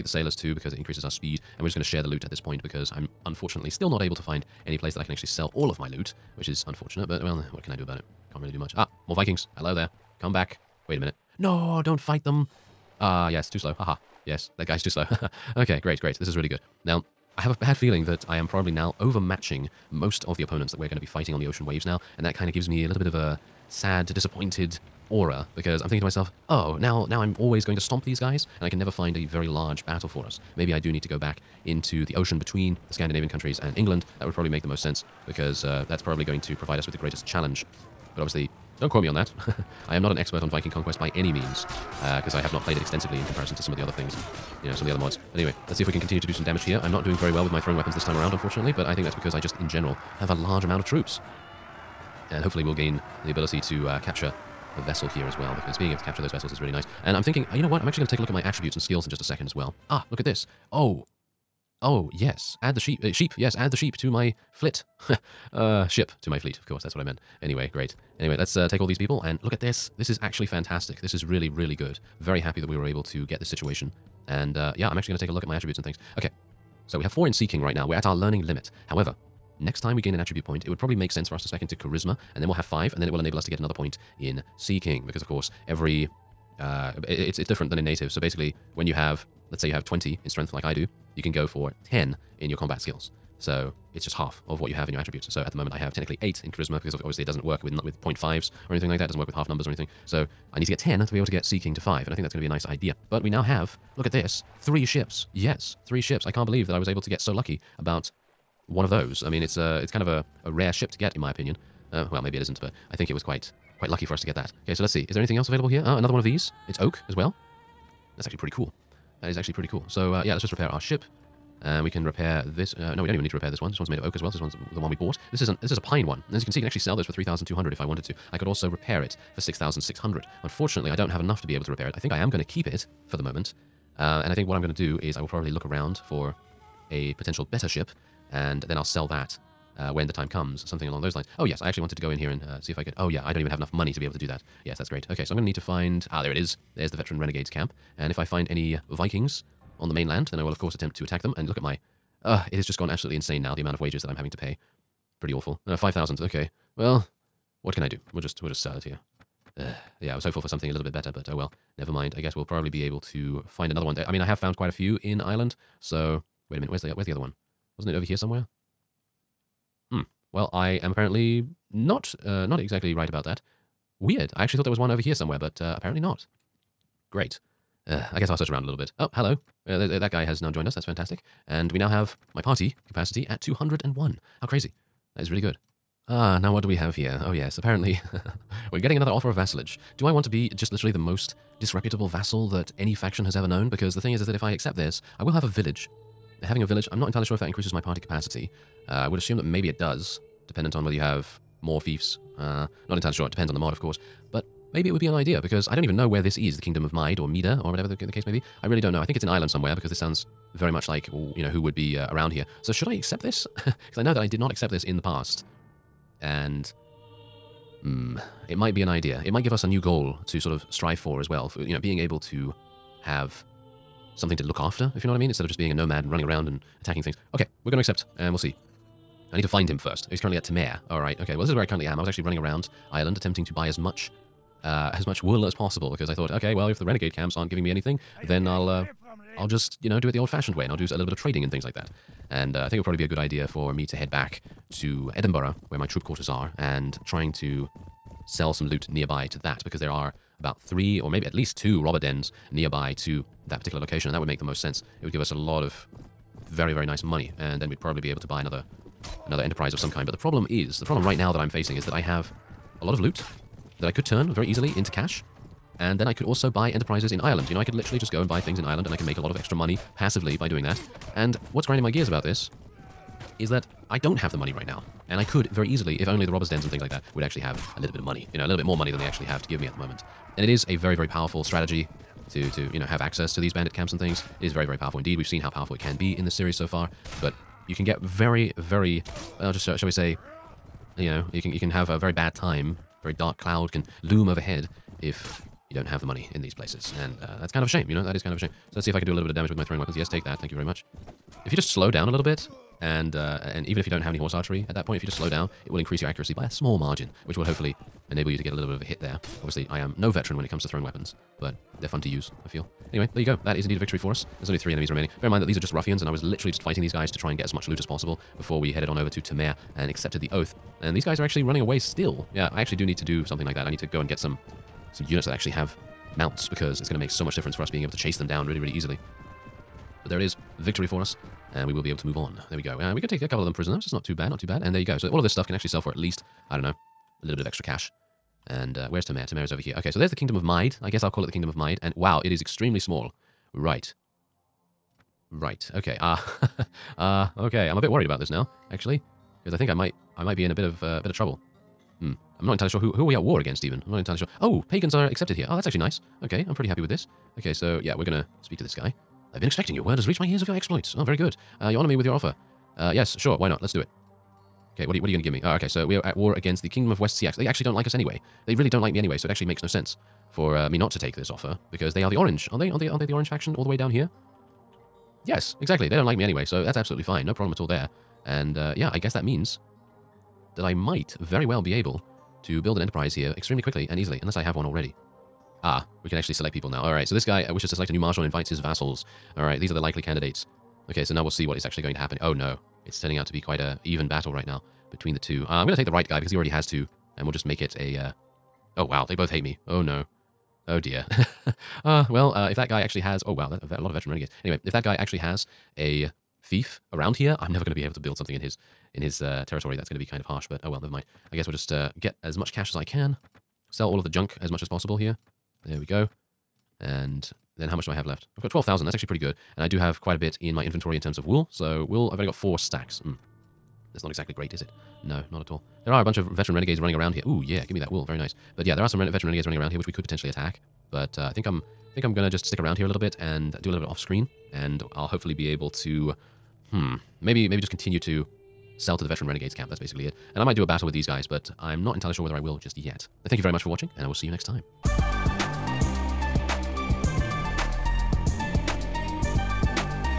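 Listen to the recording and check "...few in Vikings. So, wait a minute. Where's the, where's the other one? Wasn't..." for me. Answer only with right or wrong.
wrong.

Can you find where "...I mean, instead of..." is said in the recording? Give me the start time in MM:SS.
03:45.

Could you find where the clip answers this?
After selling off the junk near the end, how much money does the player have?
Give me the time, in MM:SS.
06:58.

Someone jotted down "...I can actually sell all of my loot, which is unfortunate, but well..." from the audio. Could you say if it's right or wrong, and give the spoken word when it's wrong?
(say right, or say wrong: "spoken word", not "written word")
right.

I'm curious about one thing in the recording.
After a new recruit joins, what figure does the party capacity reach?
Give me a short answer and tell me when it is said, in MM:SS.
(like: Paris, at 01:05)
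201, at 03:03.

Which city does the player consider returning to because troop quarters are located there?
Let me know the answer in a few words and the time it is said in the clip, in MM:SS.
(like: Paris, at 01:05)
Edinburgh, at 04:05.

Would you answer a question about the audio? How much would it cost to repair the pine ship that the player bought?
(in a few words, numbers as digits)
6,600.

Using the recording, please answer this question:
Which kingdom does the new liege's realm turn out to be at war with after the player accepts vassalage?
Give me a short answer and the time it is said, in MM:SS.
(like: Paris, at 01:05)
West Seax, at 06:06.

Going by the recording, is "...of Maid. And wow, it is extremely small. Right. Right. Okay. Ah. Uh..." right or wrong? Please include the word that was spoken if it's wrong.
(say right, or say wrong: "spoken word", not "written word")
right.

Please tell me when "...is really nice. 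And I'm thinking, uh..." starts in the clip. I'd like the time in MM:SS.
00:56.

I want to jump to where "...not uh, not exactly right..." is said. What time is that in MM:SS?
02:51.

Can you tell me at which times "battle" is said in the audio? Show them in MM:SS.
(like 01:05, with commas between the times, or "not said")
00:29, 06:34, 07:20.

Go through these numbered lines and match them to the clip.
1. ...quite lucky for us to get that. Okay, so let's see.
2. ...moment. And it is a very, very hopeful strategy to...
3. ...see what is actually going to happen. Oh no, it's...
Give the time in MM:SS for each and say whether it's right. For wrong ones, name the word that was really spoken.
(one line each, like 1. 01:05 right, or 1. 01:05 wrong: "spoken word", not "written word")
1. 01:53 right
2. 04:39 wrong: "powerful", not "hopeful"
3. 06:31 right.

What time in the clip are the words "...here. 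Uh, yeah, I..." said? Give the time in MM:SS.
02:38.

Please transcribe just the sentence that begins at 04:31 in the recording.
And what's grinding my gears about this is that I don't have the money right now.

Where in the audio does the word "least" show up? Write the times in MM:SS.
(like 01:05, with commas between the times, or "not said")
04:11, 05:35.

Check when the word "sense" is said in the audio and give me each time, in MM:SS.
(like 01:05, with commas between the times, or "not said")
00:34, 01:21, 04:14, 06:09.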